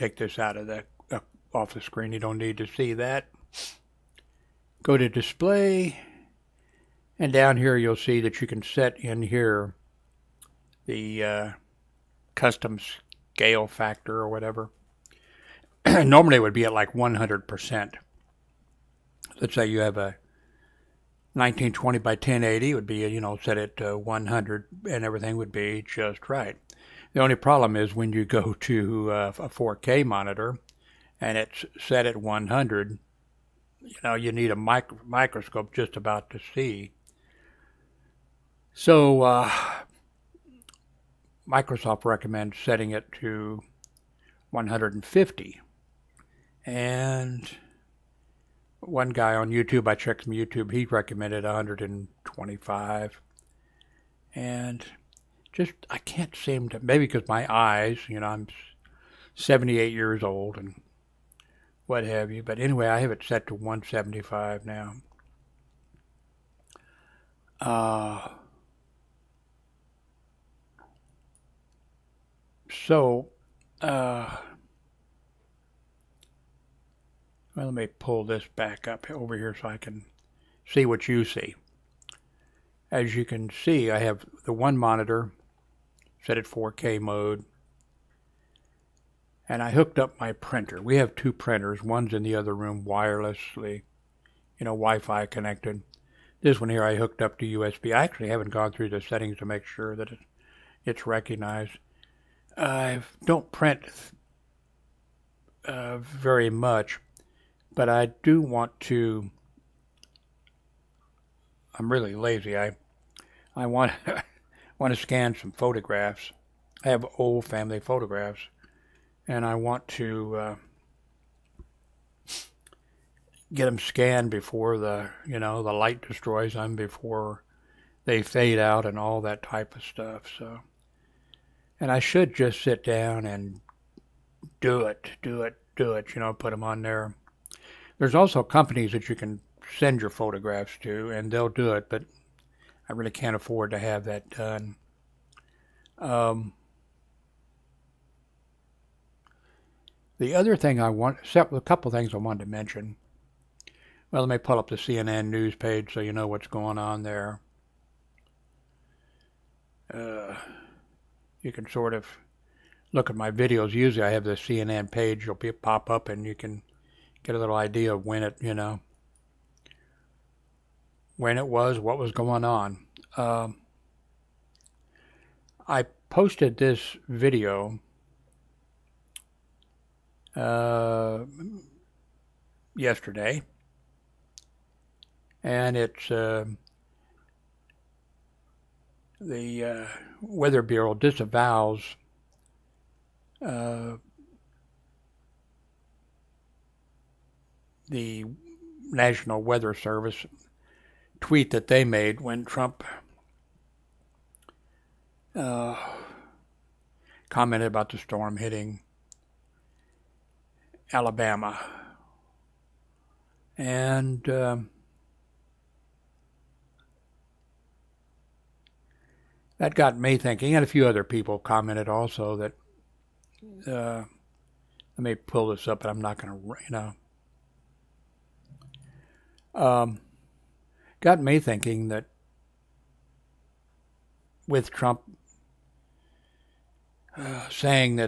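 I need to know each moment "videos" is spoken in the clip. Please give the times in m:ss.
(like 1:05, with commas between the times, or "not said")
2:43, 2:57.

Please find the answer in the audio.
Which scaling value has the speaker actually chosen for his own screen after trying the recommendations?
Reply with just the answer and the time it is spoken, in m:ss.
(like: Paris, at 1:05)
175%, at 1:03.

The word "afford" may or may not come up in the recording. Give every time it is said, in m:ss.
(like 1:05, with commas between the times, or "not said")
2:23.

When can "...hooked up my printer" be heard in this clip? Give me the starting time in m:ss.
1:29.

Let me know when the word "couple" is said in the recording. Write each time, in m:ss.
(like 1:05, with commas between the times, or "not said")
2:31.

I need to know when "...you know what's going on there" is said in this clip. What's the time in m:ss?
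2:35.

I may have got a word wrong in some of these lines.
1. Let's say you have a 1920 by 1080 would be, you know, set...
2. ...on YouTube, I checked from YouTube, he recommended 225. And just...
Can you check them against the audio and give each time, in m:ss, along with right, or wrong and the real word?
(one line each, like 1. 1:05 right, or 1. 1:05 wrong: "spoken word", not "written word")
1. 0:19 right
2. 0:49 wrong: "125", not "225".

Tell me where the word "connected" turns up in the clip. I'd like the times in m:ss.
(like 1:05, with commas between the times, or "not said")
1:35.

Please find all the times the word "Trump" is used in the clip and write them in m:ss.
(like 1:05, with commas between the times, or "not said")
3:22, 3:54.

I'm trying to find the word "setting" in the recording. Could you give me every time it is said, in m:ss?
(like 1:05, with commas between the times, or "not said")
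0:42, 1:39.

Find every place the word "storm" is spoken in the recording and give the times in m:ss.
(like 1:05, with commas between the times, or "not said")
3:27.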